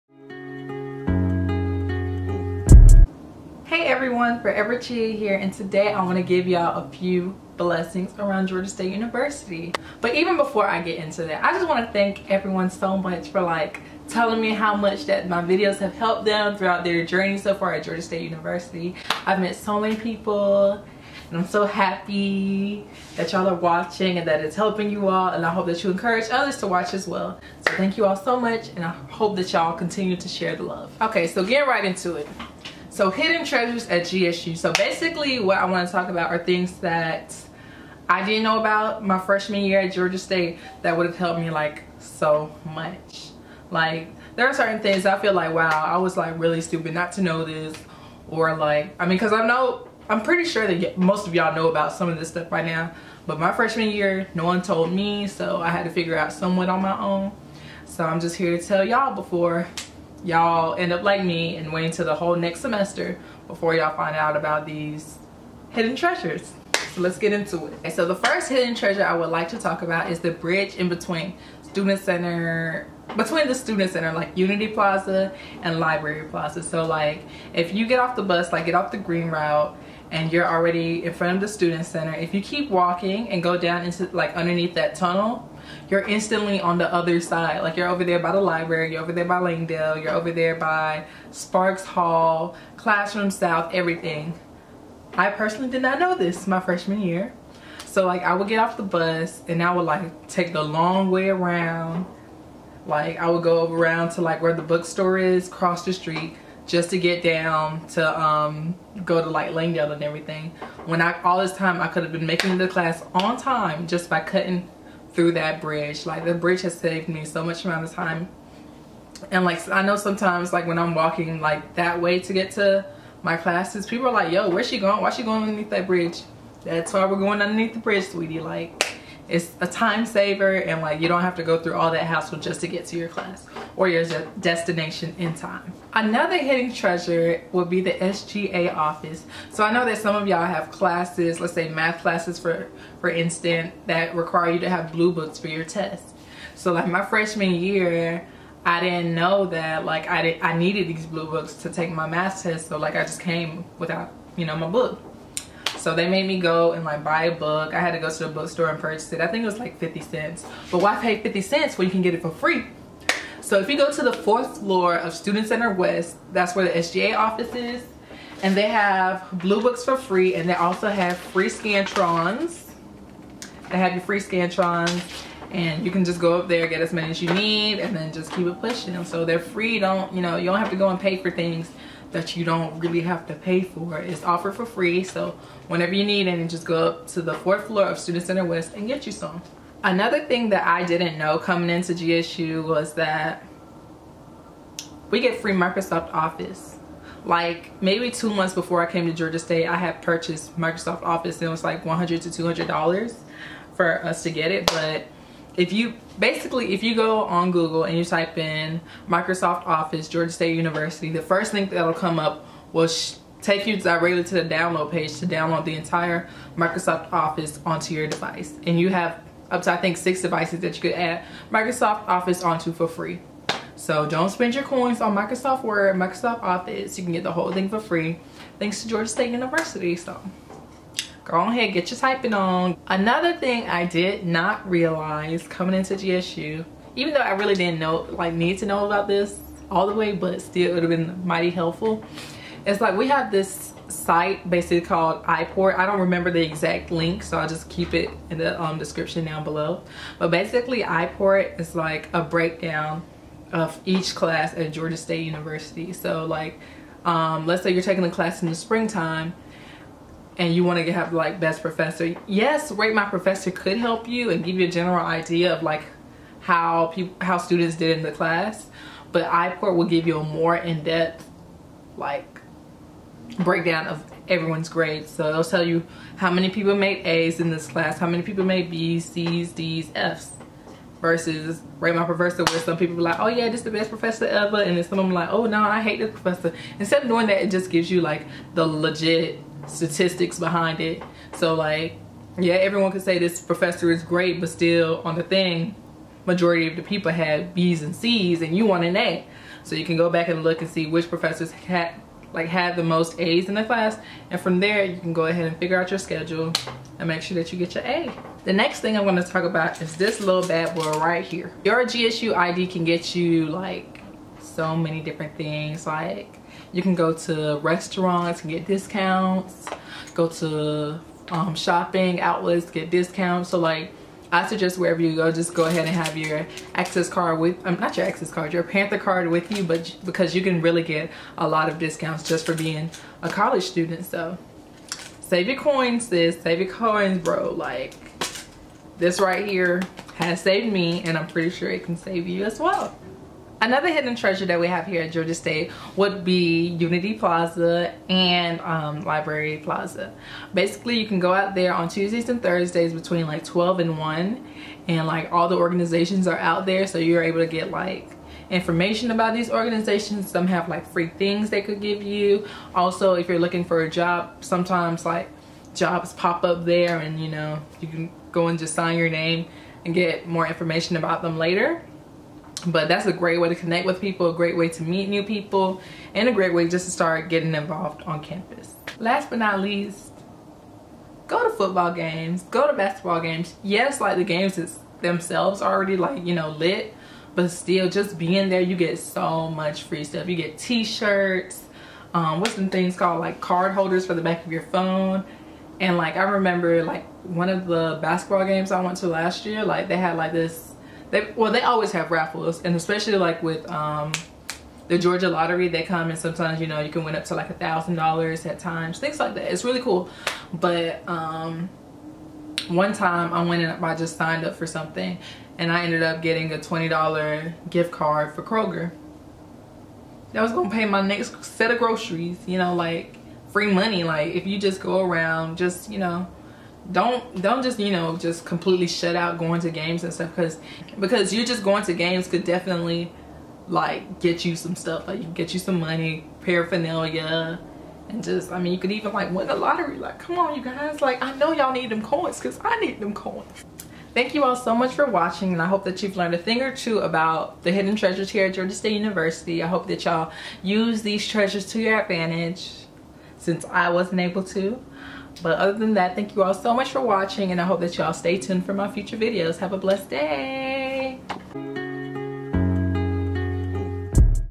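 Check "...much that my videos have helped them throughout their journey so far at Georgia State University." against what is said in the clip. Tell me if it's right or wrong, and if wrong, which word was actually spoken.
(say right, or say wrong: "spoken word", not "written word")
right.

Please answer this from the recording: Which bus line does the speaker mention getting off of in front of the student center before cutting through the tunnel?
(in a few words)
green route.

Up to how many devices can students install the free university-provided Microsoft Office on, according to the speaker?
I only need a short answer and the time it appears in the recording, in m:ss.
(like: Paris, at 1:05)
6, at 3:39.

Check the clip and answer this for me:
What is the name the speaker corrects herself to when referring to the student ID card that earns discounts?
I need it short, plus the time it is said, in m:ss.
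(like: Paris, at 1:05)
Panther card, at 5:28.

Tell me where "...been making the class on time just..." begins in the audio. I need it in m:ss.
1:52.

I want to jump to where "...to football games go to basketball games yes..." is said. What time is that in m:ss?
6:21.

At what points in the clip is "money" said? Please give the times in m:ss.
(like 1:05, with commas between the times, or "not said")
7:03, 7:15.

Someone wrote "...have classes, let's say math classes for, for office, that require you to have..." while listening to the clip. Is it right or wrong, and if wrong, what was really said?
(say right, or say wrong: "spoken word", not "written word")
wrong: "instance", not "office".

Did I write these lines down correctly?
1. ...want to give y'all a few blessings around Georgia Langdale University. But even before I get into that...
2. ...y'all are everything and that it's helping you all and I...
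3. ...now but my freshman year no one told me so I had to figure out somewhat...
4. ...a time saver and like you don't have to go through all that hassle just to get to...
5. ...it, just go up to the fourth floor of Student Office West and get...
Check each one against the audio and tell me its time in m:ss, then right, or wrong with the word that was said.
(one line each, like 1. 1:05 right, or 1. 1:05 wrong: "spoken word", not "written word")
1. 0:06 wrong: "State", not "Langdale"
2. 0:23 wrong: "watching", not "everything"
3. 0:52 right
4. 2:09 right
5. 3:06 wrong: "Center", not "Office".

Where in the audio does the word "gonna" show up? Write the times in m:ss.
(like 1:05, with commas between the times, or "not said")
5:09, 7:00.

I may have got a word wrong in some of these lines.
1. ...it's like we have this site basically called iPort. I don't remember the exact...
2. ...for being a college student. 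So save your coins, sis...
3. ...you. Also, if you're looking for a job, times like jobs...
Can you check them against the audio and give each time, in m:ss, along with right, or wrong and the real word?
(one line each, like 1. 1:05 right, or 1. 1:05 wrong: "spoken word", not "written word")
1. 4:02 right
2. 5:32 right
3. 6:02 wrong: "sometimes", not "times".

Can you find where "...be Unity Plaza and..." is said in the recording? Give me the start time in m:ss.
5:46.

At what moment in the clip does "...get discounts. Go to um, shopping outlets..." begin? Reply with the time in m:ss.
5:18.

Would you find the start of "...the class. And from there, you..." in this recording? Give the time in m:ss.
5:03.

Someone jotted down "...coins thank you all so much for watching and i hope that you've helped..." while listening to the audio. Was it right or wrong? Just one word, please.
wrong.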